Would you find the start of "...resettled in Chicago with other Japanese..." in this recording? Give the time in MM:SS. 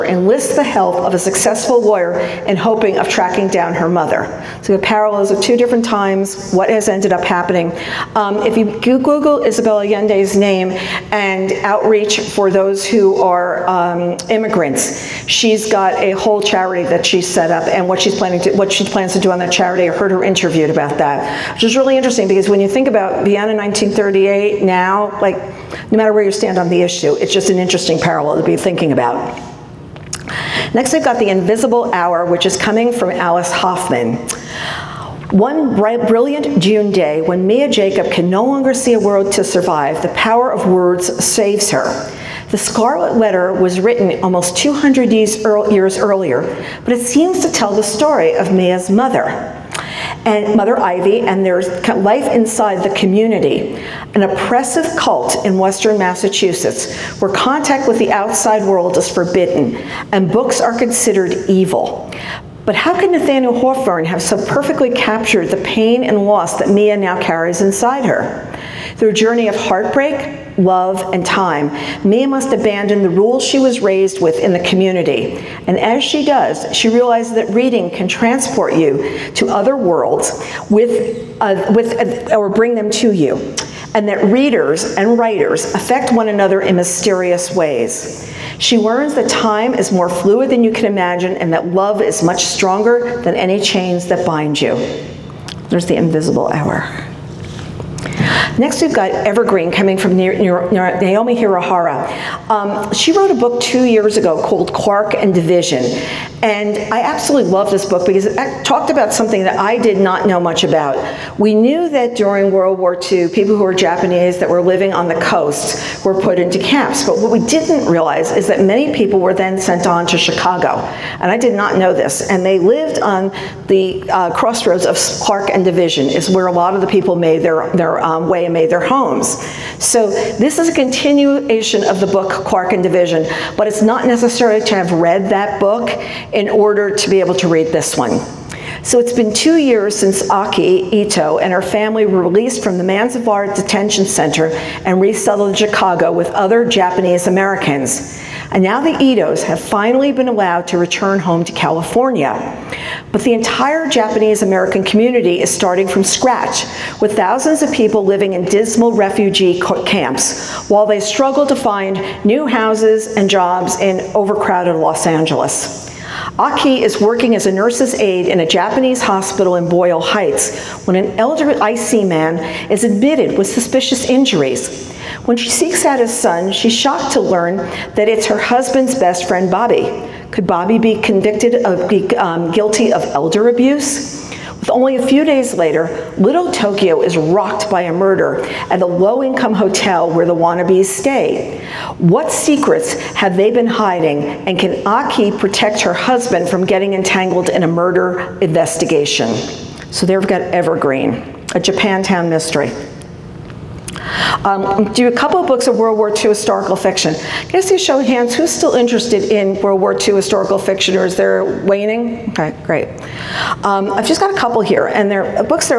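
02:25.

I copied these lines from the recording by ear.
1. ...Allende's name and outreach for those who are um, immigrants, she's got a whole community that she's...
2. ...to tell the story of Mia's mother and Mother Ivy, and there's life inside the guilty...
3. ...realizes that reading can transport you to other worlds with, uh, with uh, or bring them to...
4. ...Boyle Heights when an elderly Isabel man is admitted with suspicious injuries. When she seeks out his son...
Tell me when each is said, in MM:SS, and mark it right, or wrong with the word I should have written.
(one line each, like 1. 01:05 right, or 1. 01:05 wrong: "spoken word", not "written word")
1. 00:09 wrong: "charity", not "community"
2. 00:47 wrong: "community", not "guilty"
3. 01:16 right
4. 02:49 wrong: "Issei", not "Isabel".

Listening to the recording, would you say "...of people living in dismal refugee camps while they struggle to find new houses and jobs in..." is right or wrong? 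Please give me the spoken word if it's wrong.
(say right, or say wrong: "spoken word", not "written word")
right.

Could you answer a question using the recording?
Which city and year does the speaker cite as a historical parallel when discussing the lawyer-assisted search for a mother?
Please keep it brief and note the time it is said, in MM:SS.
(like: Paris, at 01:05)
Vienna 1938, at 00:23.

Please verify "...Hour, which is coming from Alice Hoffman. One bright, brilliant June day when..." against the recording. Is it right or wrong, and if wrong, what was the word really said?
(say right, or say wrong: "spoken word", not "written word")
right.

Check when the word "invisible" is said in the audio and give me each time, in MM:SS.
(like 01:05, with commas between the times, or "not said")
00:31, 01:35.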